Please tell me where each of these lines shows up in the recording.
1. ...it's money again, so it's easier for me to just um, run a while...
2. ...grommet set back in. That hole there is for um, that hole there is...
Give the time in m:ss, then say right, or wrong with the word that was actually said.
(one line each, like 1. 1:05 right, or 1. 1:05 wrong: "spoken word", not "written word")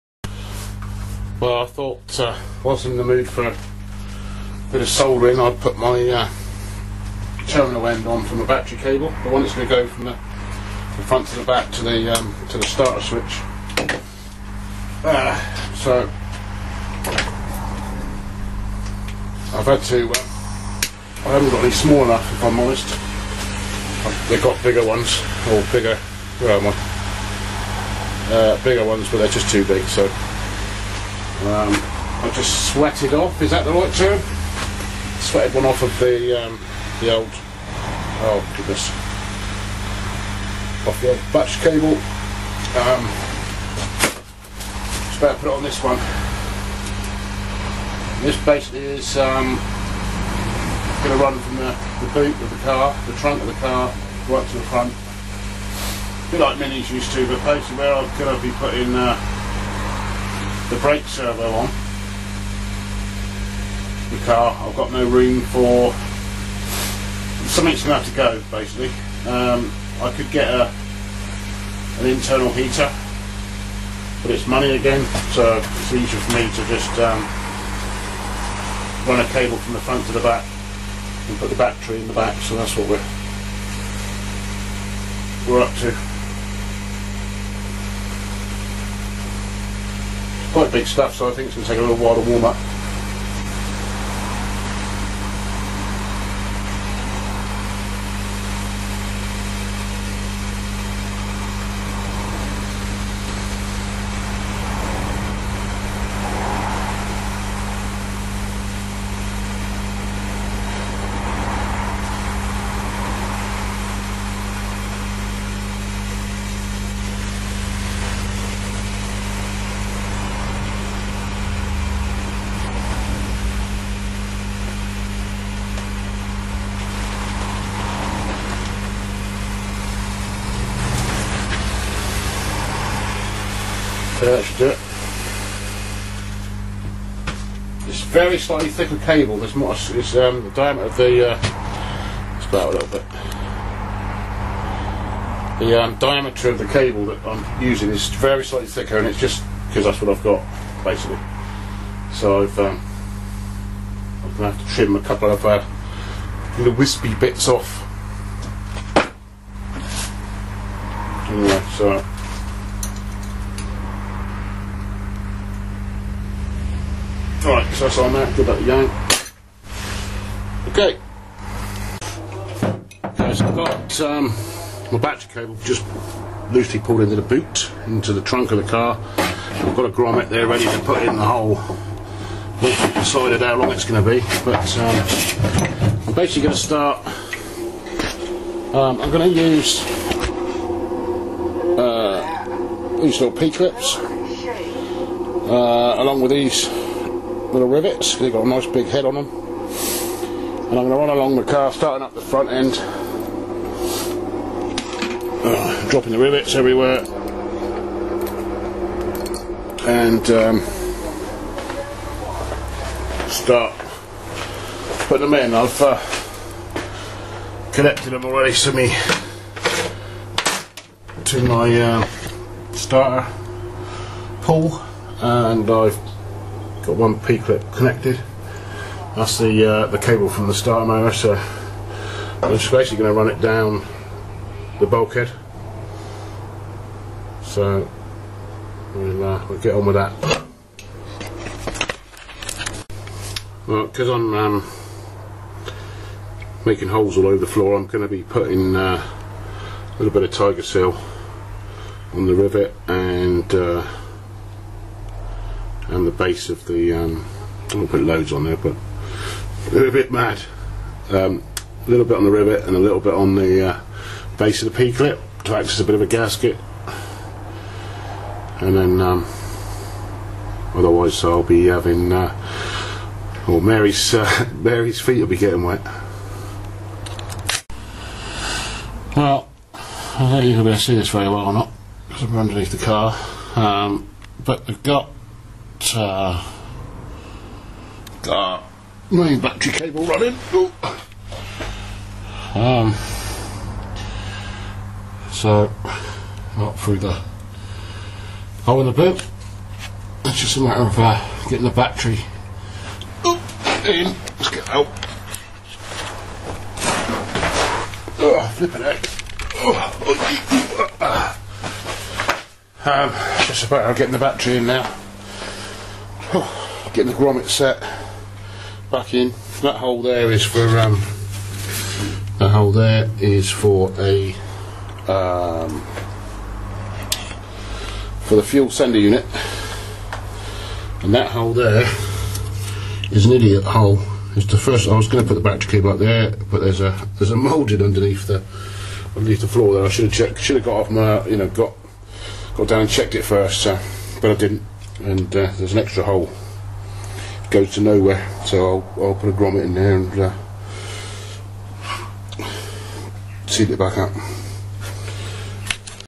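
1. 1:14 wrong: "cable", not "while"
2. 5:17 right.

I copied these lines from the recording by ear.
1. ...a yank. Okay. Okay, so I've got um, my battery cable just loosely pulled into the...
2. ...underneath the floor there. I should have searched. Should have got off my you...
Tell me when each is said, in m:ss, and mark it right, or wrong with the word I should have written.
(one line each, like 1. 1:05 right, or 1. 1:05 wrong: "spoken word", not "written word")
1. 2:48 right
2. 5:39 wrong: "checked", not "searched".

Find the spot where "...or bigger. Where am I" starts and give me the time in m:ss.
0:25.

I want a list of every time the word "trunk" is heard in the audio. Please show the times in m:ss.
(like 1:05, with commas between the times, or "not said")
0:53, 2:58.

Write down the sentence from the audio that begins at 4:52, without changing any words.
Um, so, not through the hole in the boot.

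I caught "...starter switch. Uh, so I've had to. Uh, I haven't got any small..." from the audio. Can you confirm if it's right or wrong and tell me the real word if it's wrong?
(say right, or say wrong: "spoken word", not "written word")
right.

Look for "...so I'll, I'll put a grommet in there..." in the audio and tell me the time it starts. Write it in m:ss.
5:48.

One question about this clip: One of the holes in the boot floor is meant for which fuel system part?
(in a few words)
fuel sender unit.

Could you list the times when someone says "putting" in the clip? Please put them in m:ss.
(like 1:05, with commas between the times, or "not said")
0:58, 3:35, 4:08.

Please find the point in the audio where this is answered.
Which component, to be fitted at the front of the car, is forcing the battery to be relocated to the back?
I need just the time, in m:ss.
1:00.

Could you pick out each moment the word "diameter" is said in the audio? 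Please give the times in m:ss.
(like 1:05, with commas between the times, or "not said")
2:20, 2:25.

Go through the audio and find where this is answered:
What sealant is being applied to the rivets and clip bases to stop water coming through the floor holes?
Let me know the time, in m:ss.
4:10.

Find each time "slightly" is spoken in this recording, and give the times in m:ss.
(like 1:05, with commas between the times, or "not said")
2:18, 2:28.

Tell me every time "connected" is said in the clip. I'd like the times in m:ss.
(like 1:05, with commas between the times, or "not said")
3:37, 3:47.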